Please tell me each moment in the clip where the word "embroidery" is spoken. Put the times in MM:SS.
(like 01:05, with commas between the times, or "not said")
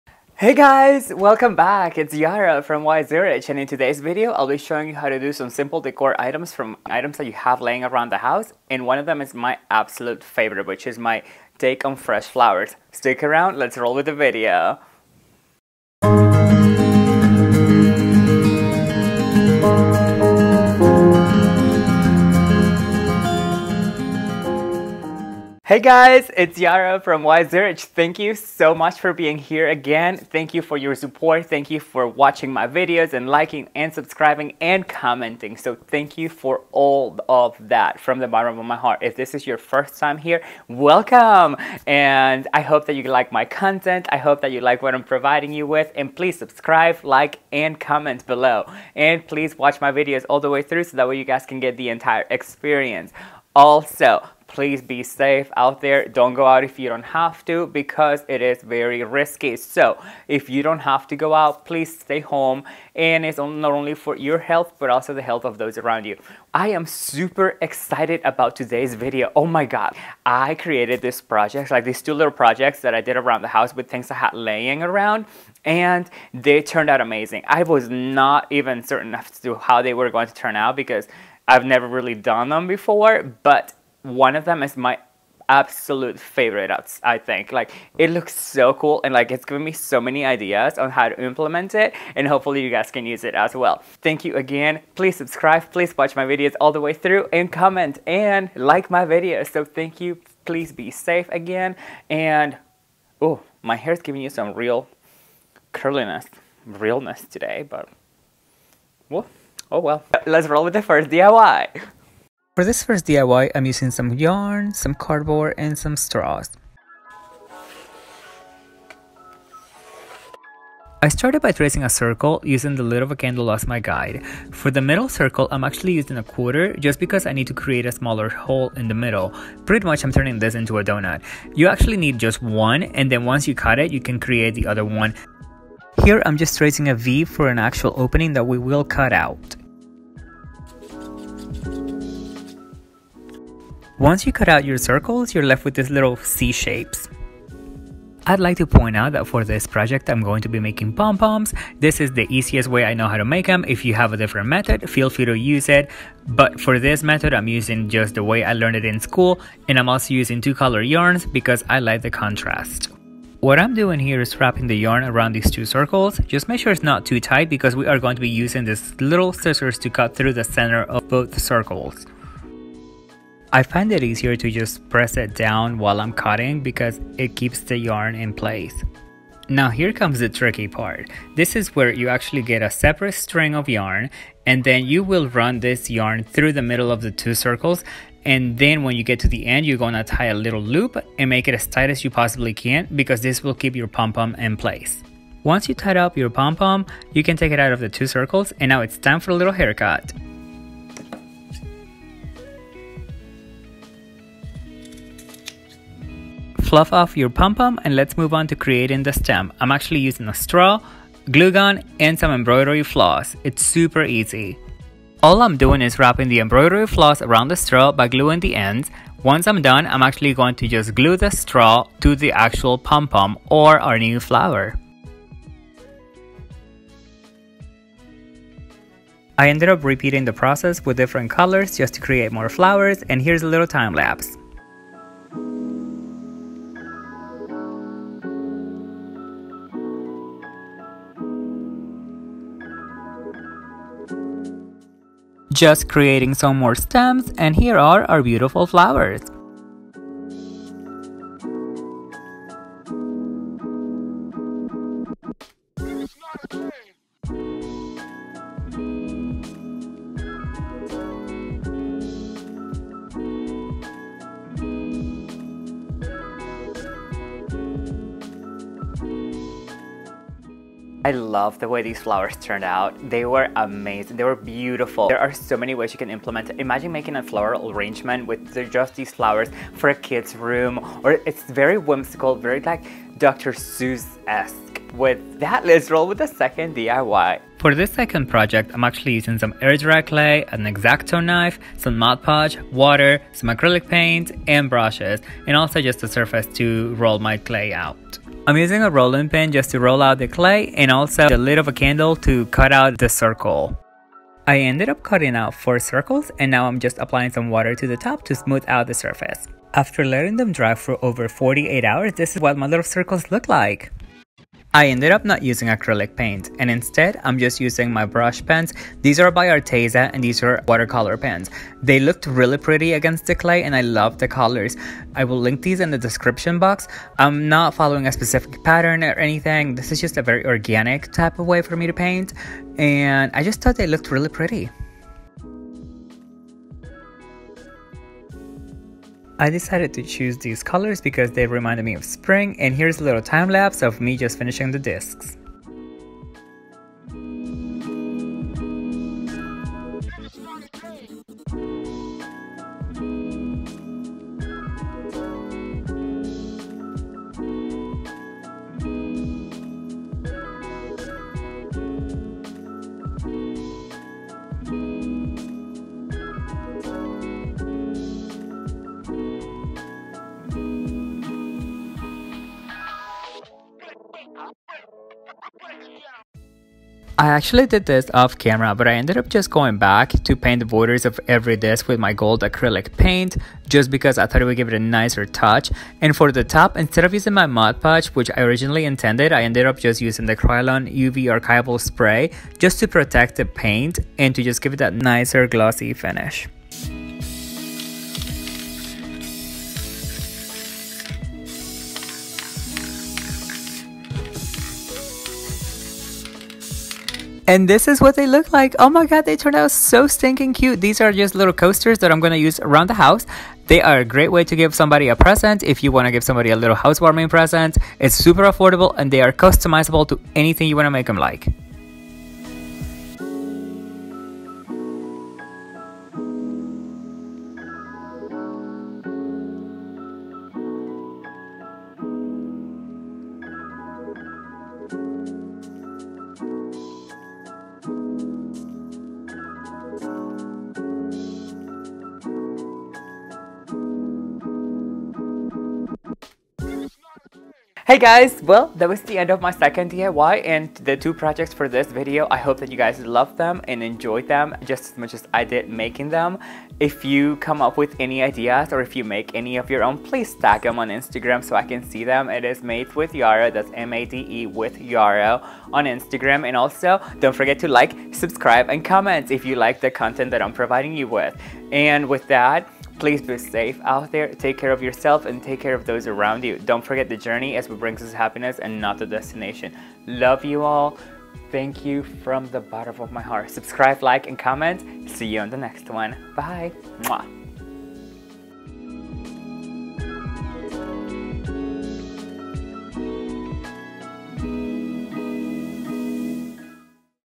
03:32, 03:36.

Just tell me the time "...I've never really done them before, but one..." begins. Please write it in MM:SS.
01:21.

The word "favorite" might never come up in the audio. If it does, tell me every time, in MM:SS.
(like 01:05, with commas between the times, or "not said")
00:10, 01:26.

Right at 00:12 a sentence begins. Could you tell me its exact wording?
Stick around, let's roll with the video!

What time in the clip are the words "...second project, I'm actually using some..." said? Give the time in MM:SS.
04:47.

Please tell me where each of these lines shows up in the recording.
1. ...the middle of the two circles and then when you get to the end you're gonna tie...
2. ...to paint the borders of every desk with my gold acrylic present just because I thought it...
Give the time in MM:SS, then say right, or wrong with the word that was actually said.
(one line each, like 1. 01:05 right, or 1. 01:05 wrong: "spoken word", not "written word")
1. 03:06 right
2. 06:20 wrong: "paint", not "present".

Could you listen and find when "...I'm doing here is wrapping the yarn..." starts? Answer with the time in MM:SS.
02:43.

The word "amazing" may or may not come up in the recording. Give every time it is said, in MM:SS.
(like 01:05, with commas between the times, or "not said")
01:16, 04:33.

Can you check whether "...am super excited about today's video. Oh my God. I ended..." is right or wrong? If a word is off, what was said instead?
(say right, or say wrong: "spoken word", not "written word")
wrong: "created", not "ended".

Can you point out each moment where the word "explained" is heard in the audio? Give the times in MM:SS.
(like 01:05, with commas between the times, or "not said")
not said.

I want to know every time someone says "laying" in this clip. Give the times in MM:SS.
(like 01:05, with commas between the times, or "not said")
00:07, 01:14.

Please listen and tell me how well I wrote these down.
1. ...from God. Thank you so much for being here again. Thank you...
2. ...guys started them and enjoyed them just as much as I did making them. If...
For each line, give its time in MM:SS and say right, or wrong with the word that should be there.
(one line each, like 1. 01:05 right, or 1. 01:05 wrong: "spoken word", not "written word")
1. 00:27 wrong: "YZuarich", not "God"
2. 07:32 wrong: "loved", not "started".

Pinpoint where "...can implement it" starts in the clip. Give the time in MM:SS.
04:35.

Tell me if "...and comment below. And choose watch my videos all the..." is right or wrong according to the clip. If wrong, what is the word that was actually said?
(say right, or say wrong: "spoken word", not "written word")
wrong: "please", not "choose".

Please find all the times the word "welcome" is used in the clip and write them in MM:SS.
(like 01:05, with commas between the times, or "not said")
00:01, 00:40.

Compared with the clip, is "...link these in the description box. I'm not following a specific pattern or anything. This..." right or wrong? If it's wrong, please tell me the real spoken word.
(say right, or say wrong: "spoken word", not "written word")
right.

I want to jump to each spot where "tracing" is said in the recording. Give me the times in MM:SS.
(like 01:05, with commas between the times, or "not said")
02:01, 02:16.